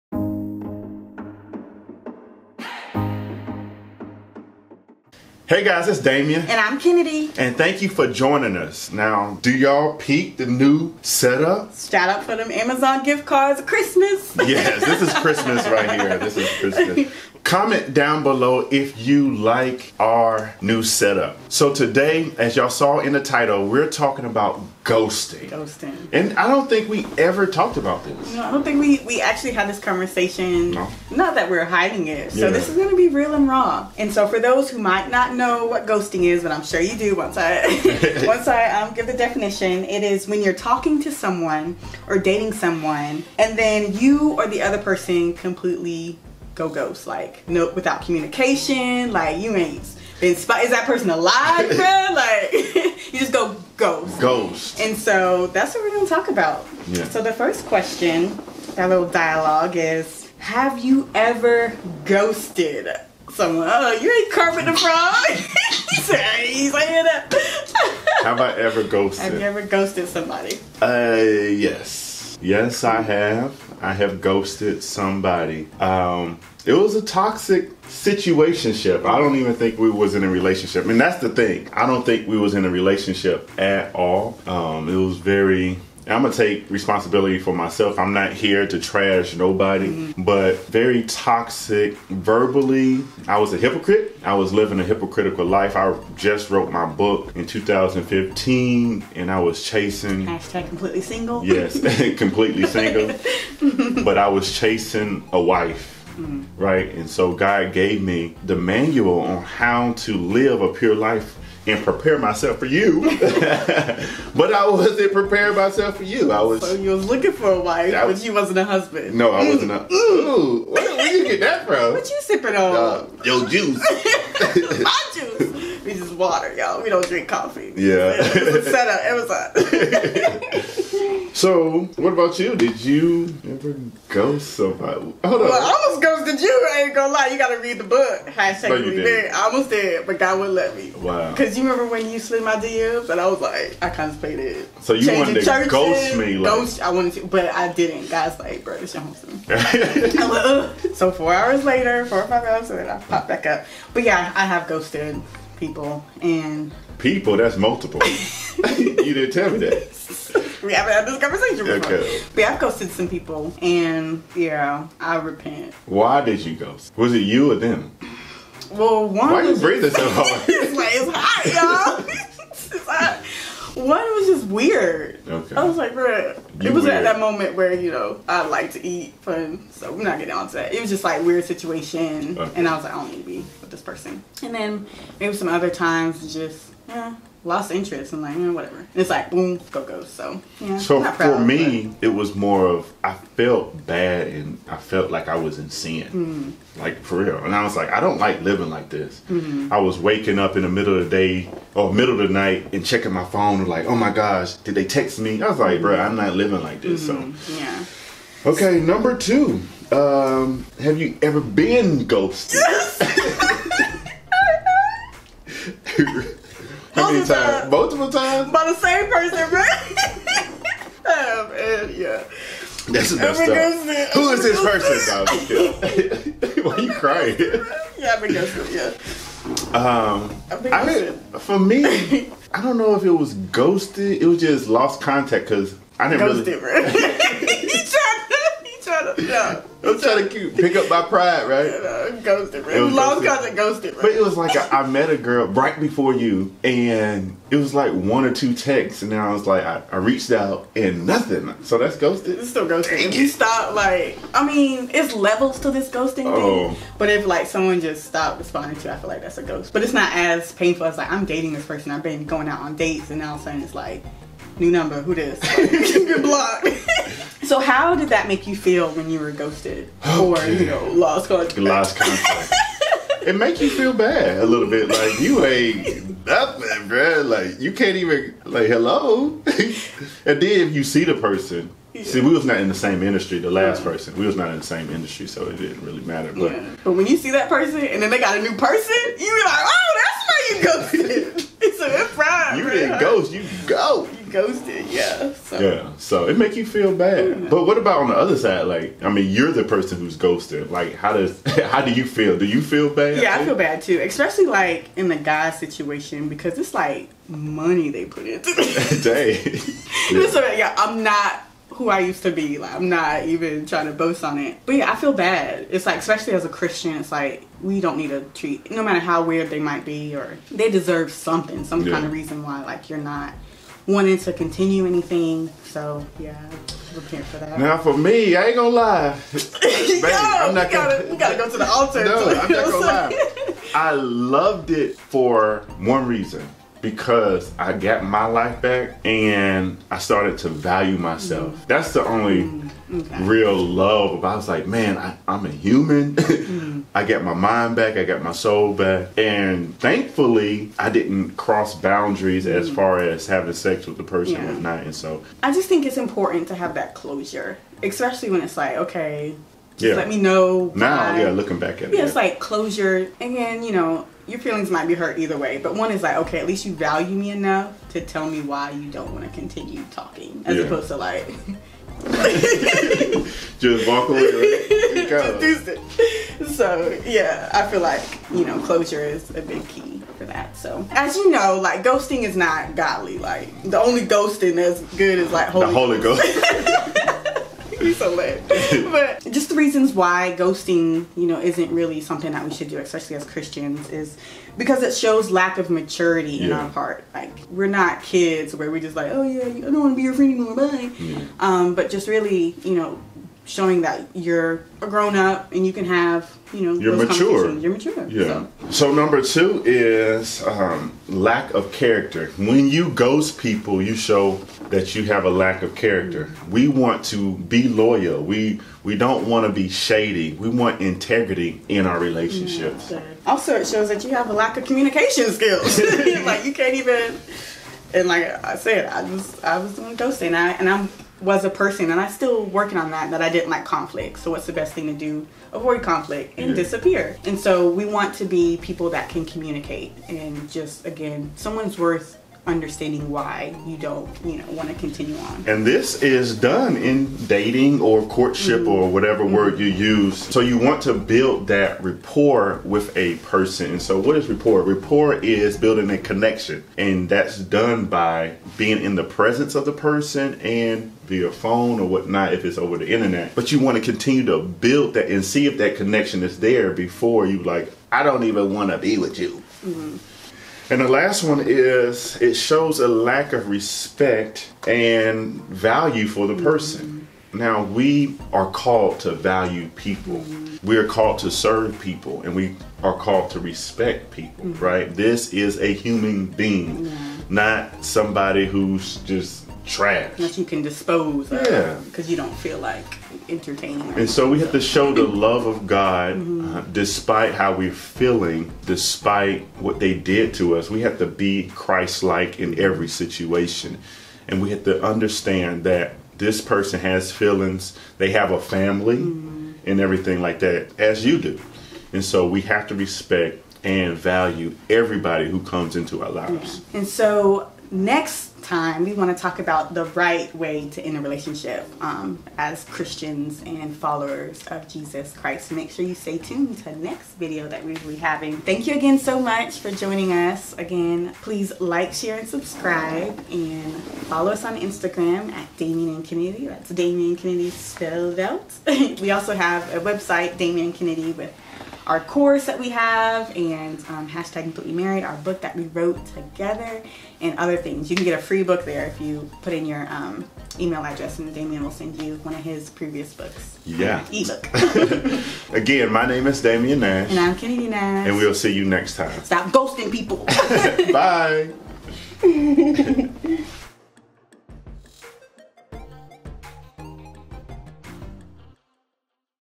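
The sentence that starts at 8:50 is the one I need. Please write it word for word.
Again, please like, share, and subscribe, and follow us on Instagram at Damien and Kenady.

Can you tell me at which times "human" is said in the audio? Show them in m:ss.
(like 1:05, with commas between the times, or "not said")
5:45, 8:05.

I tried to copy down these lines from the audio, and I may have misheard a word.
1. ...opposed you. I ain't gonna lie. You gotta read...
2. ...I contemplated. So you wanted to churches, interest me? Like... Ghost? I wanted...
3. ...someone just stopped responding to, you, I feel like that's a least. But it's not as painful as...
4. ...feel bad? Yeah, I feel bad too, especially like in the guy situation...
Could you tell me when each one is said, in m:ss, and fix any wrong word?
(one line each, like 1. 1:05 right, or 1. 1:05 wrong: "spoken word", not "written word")
1. 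2:16 wrong: "ghosted", not "opposed"
2. 2:23 wrong: "ghost", not "interest"
3. 4:17 wrong: "ghost", not "least"
4. 5:02 right.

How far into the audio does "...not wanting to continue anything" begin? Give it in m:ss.
5:22.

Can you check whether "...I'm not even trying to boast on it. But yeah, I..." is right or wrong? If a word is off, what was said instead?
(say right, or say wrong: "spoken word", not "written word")
right.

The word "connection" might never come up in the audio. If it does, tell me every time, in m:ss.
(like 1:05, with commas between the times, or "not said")
7:35, 7:45.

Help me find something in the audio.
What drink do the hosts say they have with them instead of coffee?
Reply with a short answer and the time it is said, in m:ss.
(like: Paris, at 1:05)
Water, at 2:06.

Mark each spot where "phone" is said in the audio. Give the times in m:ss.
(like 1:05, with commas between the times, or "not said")
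3:23, 7:41.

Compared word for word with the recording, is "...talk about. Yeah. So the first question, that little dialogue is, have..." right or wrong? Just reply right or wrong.
right.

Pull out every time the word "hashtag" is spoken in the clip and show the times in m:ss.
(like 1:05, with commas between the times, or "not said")
1:40, 2:18, 9:04.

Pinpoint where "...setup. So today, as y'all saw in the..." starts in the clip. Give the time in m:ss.
0:20.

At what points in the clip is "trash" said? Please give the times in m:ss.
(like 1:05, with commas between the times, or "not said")
1:28, 8:09.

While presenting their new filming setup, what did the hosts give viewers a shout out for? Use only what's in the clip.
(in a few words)
Amazon gift cards.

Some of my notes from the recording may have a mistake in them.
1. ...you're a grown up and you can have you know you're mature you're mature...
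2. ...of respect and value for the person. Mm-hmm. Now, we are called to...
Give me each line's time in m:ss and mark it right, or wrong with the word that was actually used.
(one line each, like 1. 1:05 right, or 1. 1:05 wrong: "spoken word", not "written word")
1. 6:44 right
2. 7:53 right.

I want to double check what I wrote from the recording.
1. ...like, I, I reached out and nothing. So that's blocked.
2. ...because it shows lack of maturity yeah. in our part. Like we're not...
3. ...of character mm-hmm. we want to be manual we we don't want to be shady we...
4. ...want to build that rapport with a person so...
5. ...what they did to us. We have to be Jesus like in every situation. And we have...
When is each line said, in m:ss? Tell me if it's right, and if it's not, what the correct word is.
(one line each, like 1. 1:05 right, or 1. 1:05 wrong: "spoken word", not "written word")
1. 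4:09 wrong: "ghosted", not "blocked"
2. 6:34 right
3. 6:55 wrong: "loyal", not "manual"
4. 7:30 right
5. 8:19 wrong: "Christ", not "Jesus".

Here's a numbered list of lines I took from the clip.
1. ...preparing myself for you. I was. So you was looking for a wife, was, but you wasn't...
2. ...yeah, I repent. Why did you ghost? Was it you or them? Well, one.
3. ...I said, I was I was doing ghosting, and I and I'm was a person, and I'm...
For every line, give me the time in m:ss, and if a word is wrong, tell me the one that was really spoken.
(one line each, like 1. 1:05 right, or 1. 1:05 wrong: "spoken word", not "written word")
1. 1:55 right
2. 2:44 right
3. 7:08 right.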